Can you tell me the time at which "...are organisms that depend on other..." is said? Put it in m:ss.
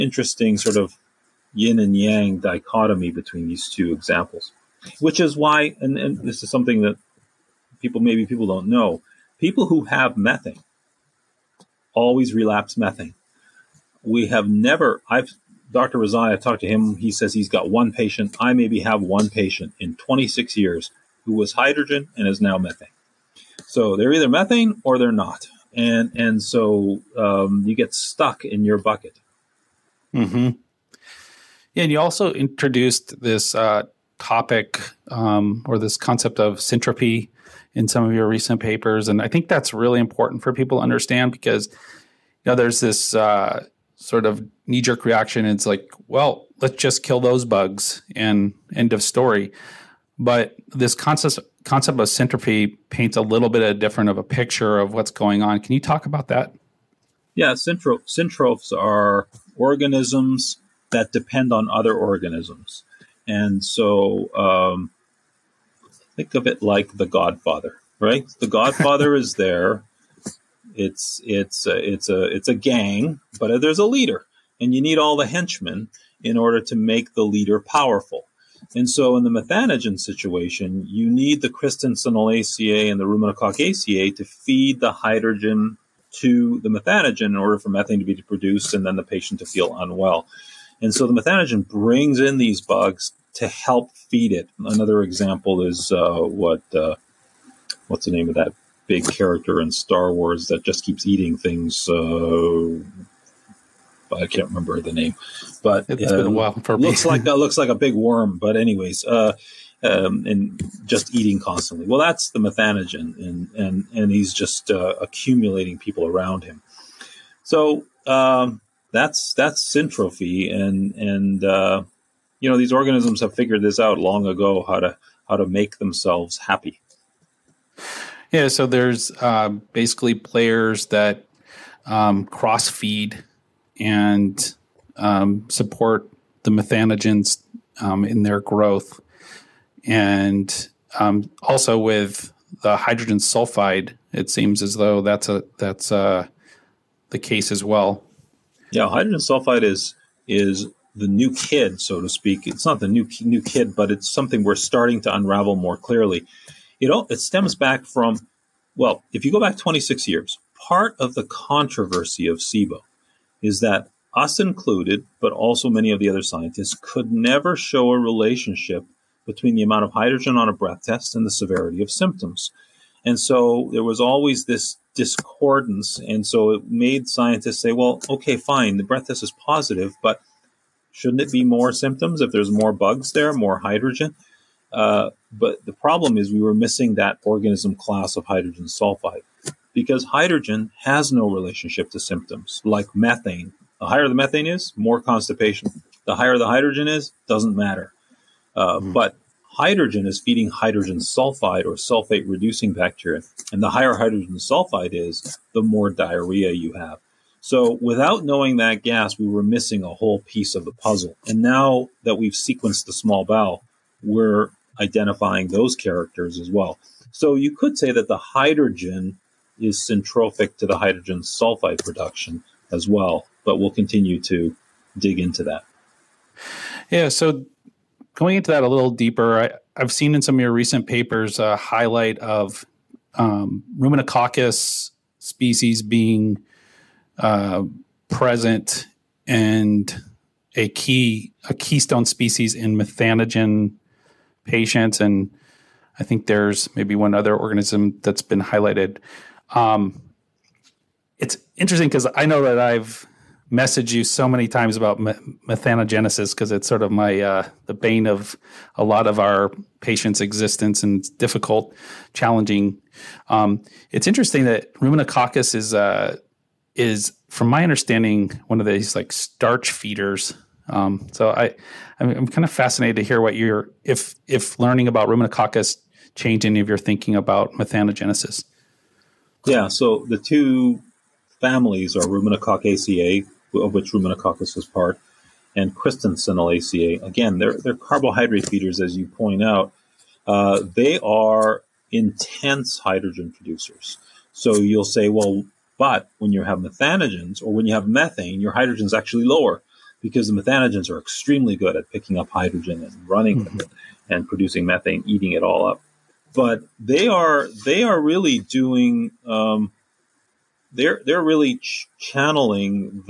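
0:58.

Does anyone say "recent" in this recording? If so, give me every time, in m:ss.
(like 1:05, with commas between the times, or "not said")
0:38, 3:50.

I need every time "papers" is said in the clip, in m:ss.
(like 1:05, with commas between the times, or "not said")
0:38, 3:50.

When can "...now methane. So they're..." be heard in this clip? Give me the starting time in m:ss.
0:22.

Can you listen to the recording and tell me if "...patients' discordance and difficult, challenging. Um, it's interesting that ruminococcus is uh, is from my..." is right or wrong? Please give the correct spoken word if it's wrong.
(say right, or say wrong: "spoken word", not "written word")
wrong: "existence", not "discordance".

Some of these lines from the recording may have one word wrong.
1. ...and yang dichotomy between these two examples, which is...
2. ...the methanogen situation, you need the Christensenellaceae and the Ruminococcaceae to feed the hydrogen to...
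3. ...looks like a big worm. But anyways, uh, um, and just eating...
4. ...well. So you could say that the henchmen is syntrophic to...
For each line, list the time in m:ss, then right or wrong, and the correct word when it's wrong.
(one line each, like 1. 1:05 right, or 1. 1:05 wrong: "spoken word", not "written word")
1. 0:01 right
2. 1:19 right
3. 1:47 right
4. 3:36 wrong: "hydrogen", not "henchmen".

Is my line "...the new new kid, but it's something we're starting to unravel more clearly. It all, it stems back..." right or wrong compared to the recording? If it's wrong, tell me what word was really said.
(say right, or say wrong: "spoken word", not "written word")
right.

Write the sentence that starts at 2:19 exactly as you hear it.
And um, also with the hydrogen sulfide, it seems as though that's a that's a, uh, the case as well.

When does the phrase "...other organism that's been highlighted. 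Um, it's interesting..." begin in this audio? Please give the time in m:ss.
4:07.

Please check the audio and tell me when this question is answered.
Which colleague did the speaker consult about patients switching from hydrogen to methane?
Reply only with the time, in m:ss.
0:15.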